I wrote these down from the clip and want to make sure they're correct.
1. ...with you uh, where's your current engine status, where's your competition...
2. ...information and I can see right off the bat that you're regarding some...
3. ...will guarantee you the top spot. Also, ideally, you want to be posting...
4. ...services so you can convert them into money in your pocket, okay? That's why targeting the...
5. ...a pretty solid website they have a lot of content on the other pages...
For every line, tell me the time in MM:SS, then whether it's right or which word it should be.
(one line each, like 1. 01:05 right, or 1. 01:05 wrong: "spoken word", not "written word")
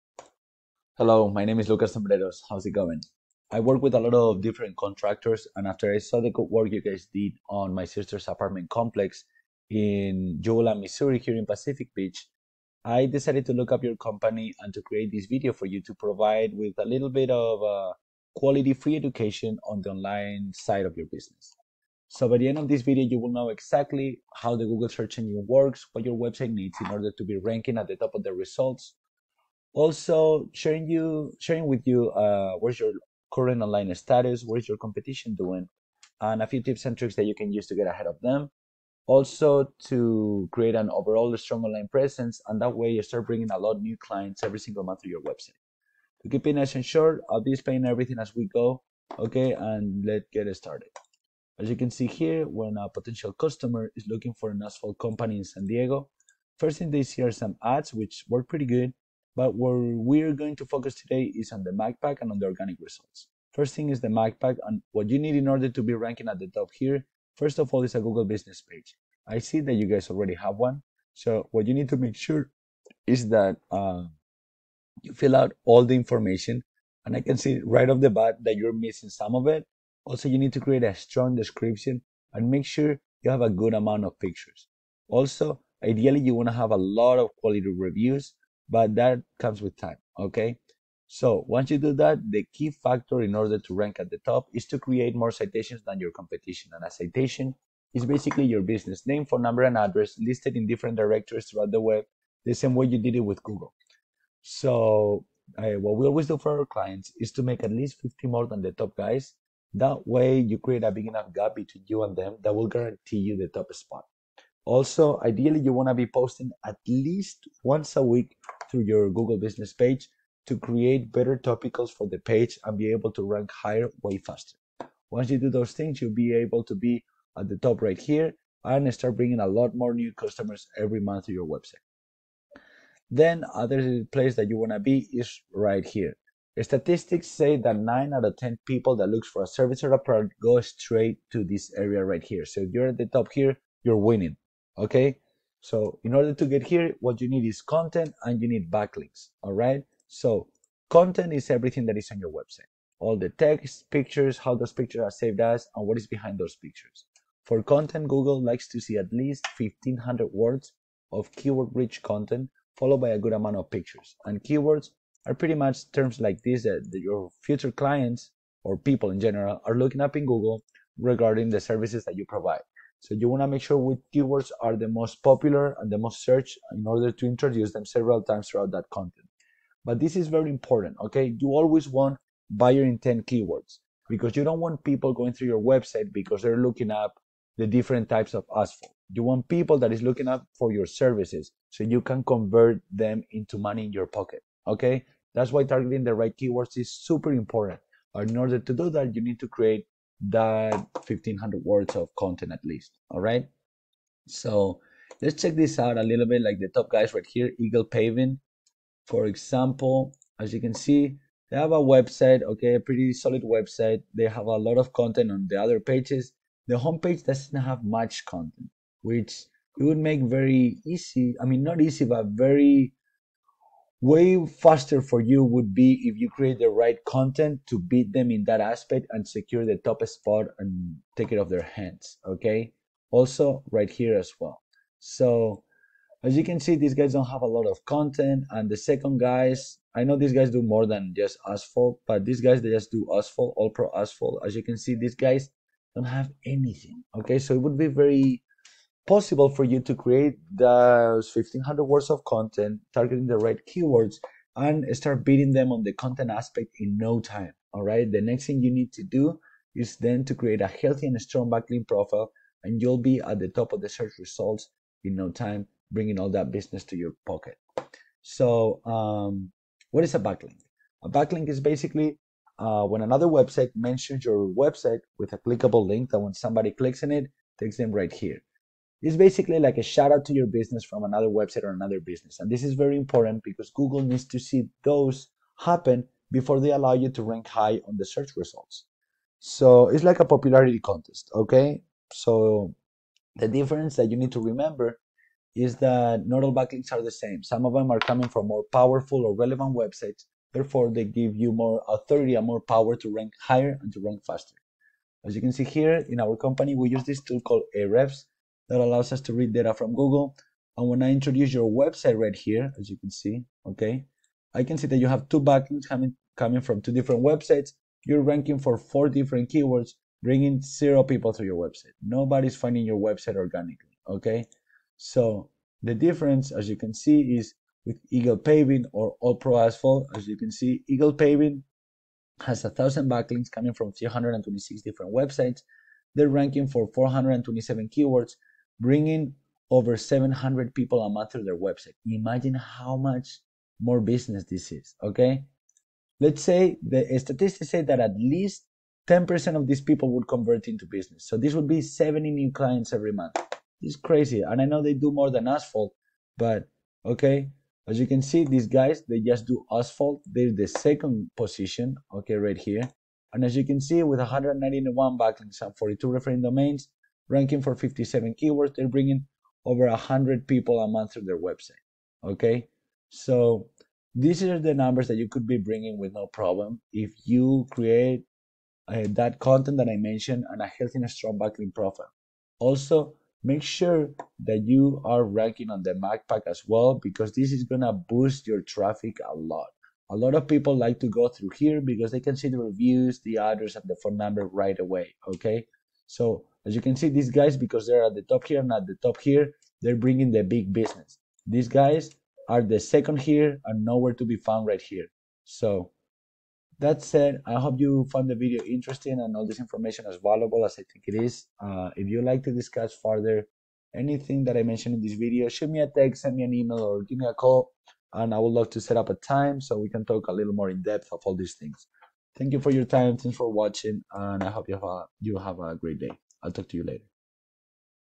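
1. 00:31 wrong: "online", not "engine"
2. 01:15 wrong: "missing", not "regarding"
3. 01:52 right
4. 03:10 right
5. 03:32 right.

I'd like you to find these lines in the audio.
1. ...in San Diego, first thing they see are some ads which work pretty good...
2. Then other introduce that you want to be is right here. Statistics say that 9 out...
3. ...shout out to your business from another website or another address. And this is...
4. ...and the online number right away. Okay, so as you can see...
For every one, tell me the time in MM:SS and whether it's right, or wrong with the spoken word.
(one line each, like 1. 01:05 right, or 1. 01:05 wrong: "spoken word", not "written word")
1. 00:55 right
2. 02:13 wrong: "place", not "introduce"
3. 04:39 wrong: "business", not "address"
4. 06:33 wrong: "phone", not "online".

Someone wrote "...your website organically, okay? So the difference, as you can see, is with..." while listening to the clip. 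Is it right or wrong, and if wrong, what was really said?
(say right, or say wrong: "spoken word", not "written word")
right.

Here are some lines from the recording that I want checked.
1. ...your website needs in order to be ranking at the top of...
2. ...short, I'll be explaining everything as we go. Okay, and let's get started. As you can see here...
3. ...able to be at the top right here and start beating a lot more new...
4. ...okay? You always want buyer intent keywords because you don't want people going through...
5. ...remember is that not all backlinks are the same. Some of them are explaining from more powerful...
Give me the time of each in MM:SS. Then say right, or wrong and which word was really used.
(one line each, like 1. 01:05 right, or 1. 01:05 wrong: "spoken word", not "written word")
1. 00:26 right
2. 00:46 right
3. 02:06 wrong: "bringing", not "beating"
4. 03:01 right
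5. 04:54 wrong: "coming", not "explaining".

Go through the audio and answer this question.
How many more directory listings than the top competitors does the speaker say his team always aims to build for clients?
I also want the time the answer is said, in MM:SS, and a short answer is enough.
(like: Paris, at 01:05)
50, at 01:47.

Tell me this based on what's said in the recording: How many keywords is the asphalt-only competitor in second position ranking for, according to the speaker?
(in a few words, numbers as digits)
57.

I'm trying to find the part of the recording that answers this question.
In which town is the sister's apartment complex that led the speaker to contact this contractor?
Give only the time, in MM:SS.
00:10.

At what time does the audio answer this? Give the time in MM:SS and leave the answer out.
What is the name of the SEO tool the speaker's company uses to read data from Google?
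05:07.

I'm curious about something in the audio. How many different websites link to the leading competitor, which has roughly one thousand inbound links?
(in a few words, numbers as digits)
326.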